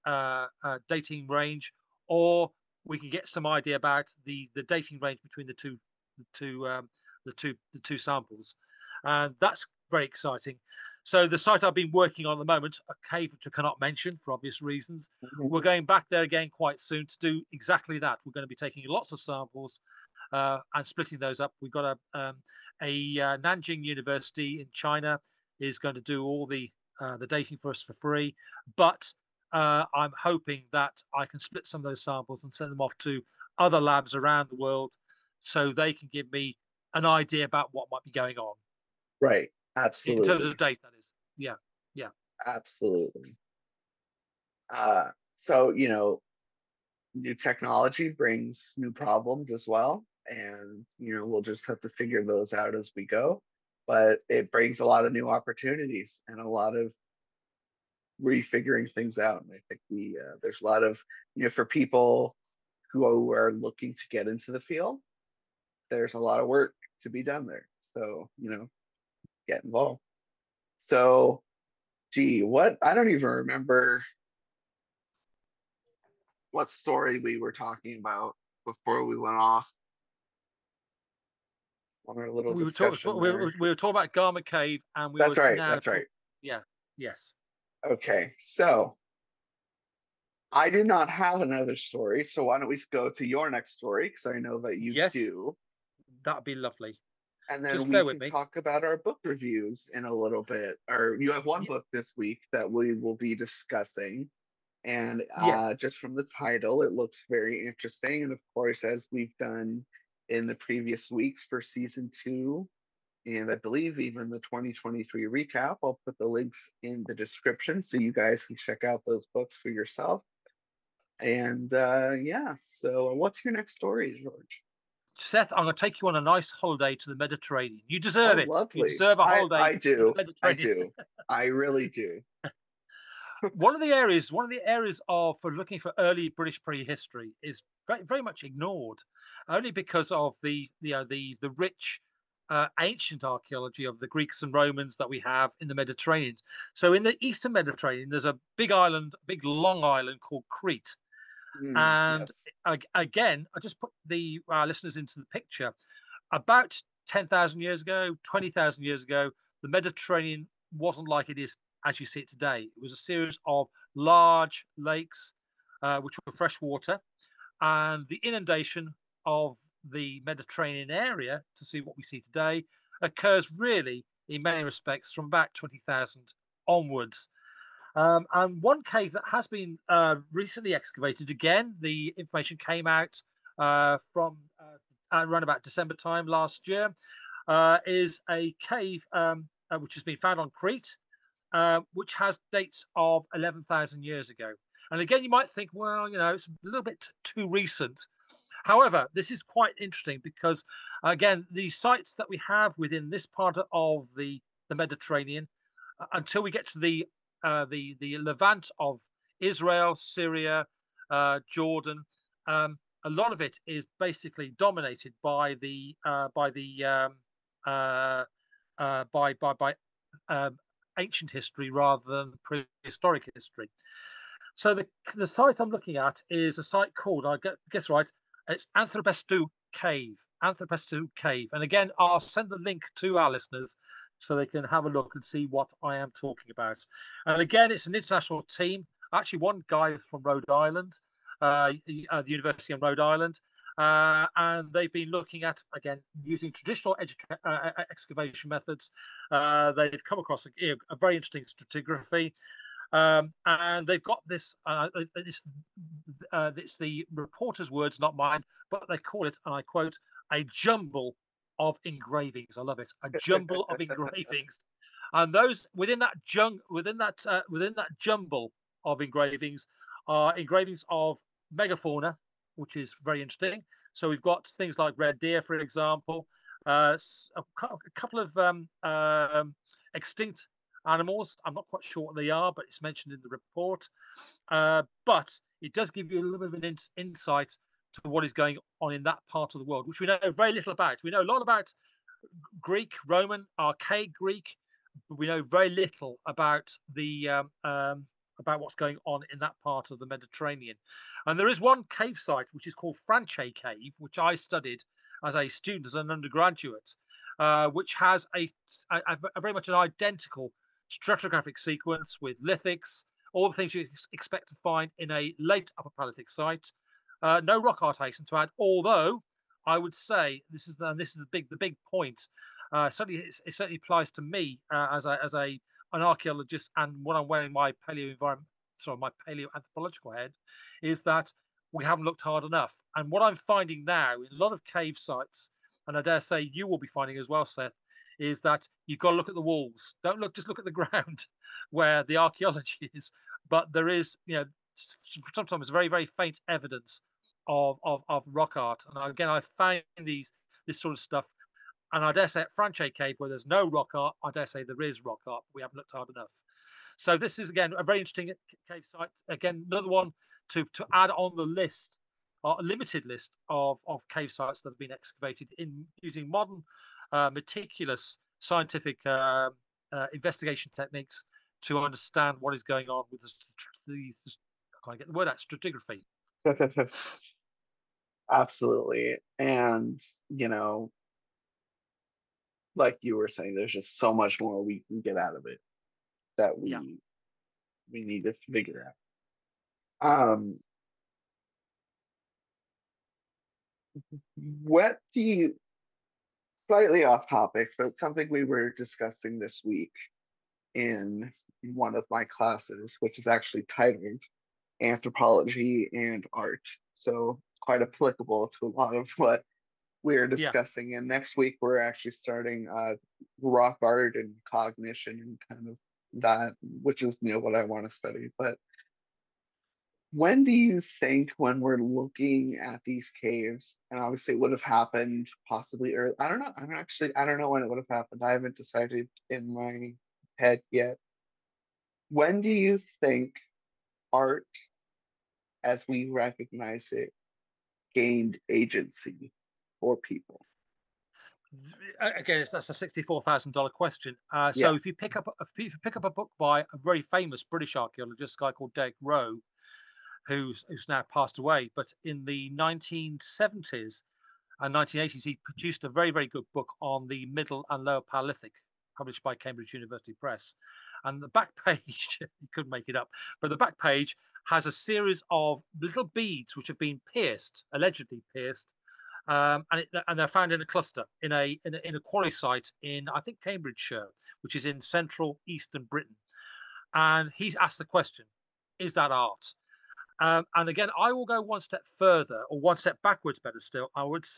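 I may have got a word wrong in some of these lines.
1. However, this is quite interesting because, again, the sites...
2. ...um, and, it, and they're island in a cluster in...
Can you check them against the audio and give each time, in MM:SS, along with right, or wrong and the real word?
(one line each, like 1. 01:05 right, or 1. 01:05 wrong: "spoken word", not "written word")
1. 03:18 right
2. 07:49 wrong: "found", not "island".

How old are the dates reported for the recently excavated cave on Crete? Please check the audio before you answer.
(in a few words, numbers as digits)
11,000 years.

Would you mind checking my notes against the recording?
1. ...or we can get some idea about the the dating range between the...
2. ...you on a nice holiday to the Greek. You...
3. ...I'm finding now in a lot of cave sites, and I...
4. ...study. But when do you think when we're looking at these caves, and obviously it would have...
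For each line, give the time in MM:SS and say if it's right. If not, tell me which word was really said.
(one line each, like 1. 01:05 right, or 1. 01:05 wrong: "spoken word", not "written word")
1. 00:02 right
2. 02:06 wrong: "Mediterranean", not "Greek"
3. 05:33 right
4. 06:57 right.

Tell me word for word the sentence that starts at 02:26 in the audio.
So in the eastern Mediterranean, there's a big island, big long island called Crete, Mm, and yes.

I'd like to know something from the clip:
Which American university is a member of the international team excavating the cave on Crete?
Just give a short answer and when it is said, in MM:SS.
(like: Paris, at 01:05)
University of Rhode Island, at 04:02.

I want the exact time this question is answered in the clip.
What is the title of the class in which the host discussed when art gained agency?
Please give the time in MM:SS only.
06:44.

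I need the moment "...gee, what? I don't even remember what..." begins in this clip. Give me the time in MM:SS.
01:12.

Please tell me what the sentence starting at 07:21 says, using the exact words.
Again, that's a sixty-four thousand dollar question.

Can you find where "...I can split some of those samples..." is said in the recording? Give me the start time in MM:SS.
00:31.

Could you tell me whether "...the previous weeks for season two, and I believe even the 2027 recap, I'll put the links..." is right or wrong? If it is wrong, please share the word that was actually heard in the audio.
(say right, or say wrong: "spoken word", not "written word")
wrong: "2023", not "2027".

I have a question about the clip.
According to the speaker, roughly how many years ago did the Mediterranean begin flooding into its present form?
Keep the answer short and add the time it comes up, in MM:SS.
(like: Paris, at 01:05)
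20,000, at 02:55.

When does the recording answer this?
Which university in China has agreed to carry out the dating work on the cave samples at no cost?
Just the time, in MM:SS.
00:23.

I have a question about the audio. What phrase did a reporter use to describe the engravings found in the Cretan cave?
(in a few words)
a jumble of engravings.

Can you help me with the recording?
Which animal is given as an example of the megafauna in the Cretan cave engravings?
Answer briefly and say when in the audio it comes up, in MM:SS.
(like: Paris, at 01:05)
red deer, at 04:34.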